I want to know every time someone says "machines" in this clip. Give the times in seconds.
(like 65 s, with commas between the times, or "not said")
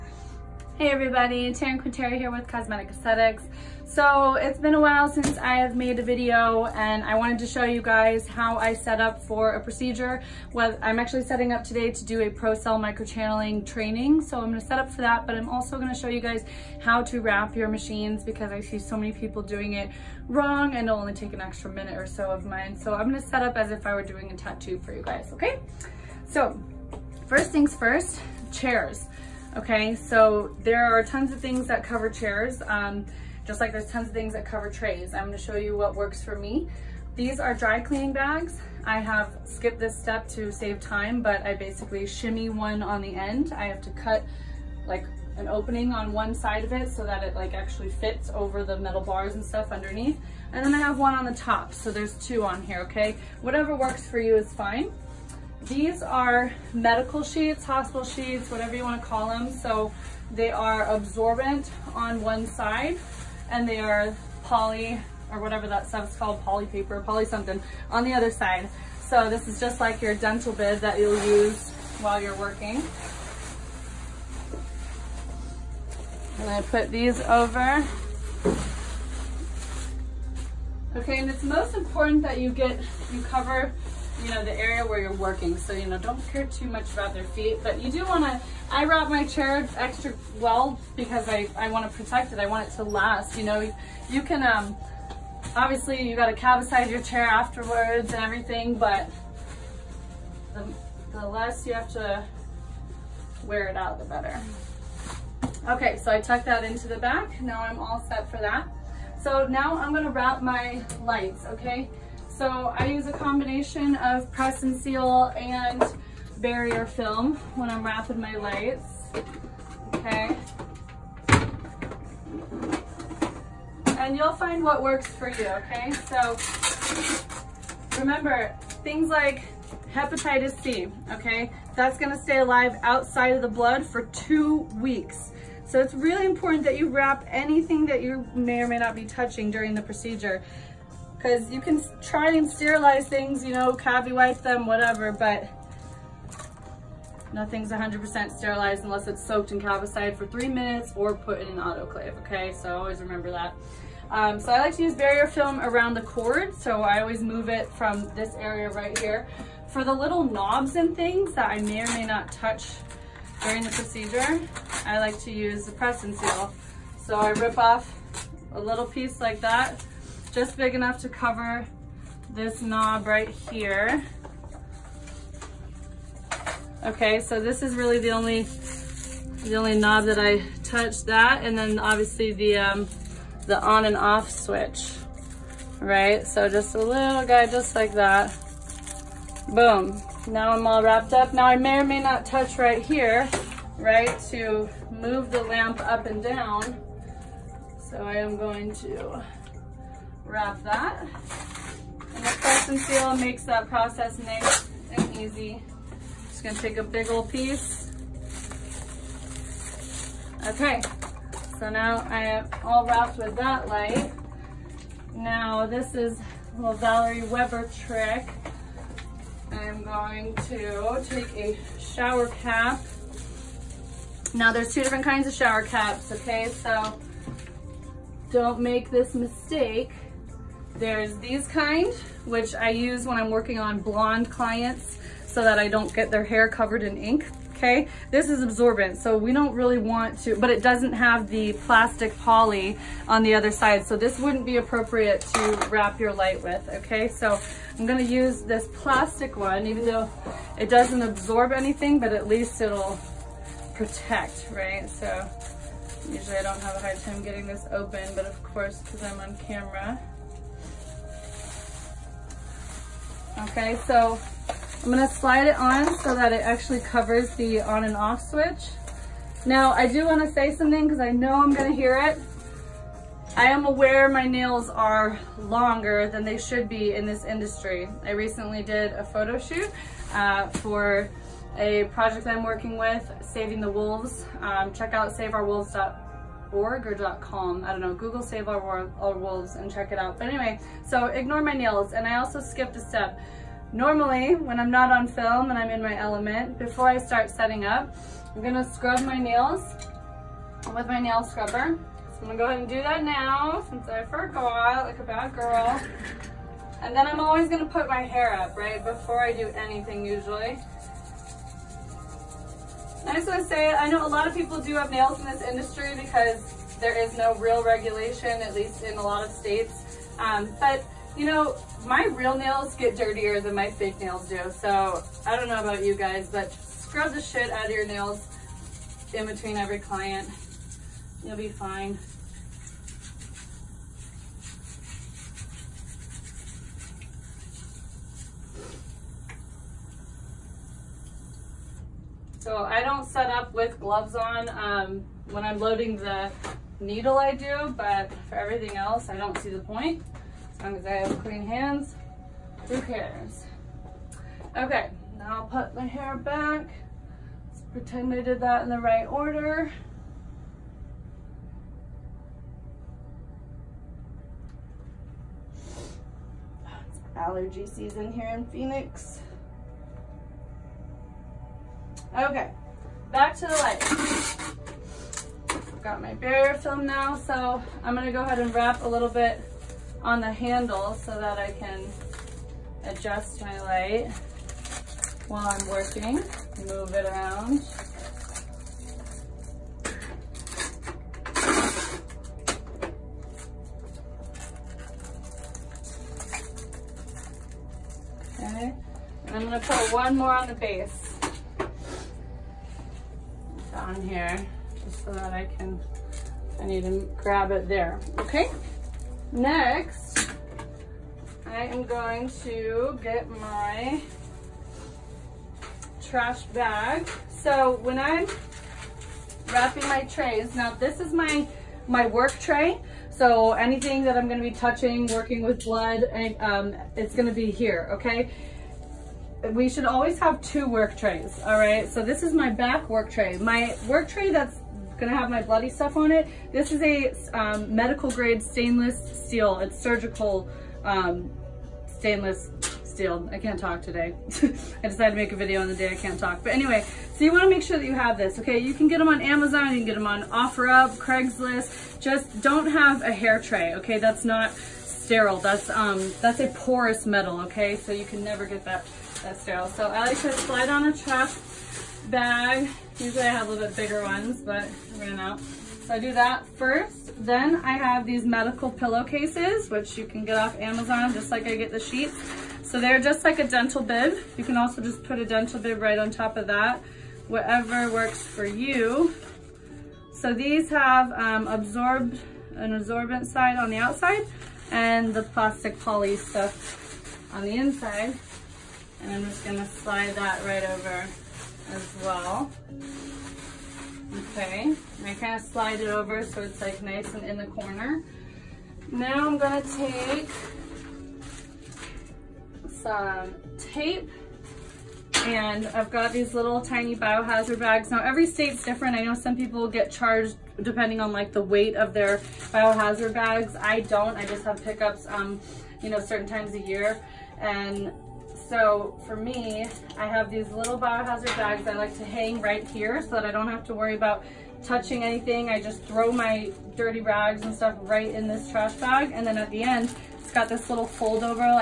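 17 s.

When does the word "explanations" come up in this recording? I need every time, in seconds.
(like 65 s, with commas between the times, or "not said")
not said.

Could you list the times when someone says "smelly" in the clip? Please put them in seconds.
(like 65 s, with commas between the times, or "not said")
not said.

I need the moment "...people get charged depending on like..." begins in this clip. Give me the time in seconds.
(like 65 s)
509 s.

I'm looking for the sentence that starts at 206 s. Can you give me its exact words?
Just gonna take a big old piece.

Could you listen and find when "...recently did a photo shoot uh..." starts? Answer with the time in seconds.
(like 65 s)
278 s.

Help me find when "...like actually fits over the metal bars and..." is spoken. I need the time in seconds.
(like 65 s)
47 s.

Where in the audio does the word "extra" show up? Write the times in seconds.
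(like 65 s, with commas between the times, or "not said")
21 s, 89 s.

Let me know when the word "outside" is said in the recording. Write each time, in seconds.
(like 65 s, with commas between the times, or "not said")
132 s, 483 s.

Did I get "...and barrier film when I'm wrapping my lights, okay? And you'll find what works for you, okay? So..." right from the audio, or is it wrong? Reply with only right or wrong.
right.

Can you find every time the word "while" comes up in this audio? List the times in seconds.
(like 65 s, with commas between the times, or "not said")
4 s, 72 s, 385 s.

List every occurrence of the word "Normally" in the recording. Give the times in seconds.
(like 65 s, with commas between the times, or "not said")
293 s.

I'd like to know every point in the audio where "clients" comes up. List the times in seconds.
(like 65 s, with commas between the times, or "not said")
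234 s, 329 s.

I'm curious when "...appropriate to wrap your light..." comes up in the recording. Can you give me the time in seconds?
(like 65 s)
244 s.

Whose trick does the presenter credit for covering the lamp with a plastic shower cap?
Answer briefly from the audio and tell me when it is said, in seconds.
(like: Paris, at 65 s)
Valerie Weber, at 216 s.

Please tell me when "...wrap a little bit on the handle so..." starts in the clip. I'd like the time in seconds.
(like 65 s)
378 s.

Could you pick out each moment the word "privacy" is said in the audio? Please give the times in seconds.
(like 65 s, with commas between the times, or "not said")
not said.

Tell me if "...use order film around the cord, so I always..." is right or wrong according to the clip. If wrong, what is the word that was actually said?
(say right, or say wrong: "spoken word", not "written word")
wrong: "barrier", not "order".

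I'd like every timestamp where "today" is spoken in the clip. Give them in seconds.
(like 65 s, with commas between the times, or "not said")
11 s, 443 s.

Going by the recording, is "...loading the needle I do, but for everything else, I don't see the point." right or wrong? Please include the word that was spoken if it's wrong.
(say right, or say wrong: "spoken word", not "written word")
right.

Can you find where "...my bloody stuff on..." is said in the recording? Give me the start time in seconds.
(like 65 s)
435 s.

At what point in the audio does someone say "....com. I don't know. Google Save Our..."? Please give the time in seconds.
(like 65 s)
287 s.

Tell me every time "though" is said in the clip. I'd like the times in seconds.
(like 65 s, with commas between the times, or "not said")
249 s.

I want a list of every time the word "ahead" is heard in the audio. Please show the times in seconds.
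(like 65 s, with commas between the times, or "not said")
302 s, 378 s.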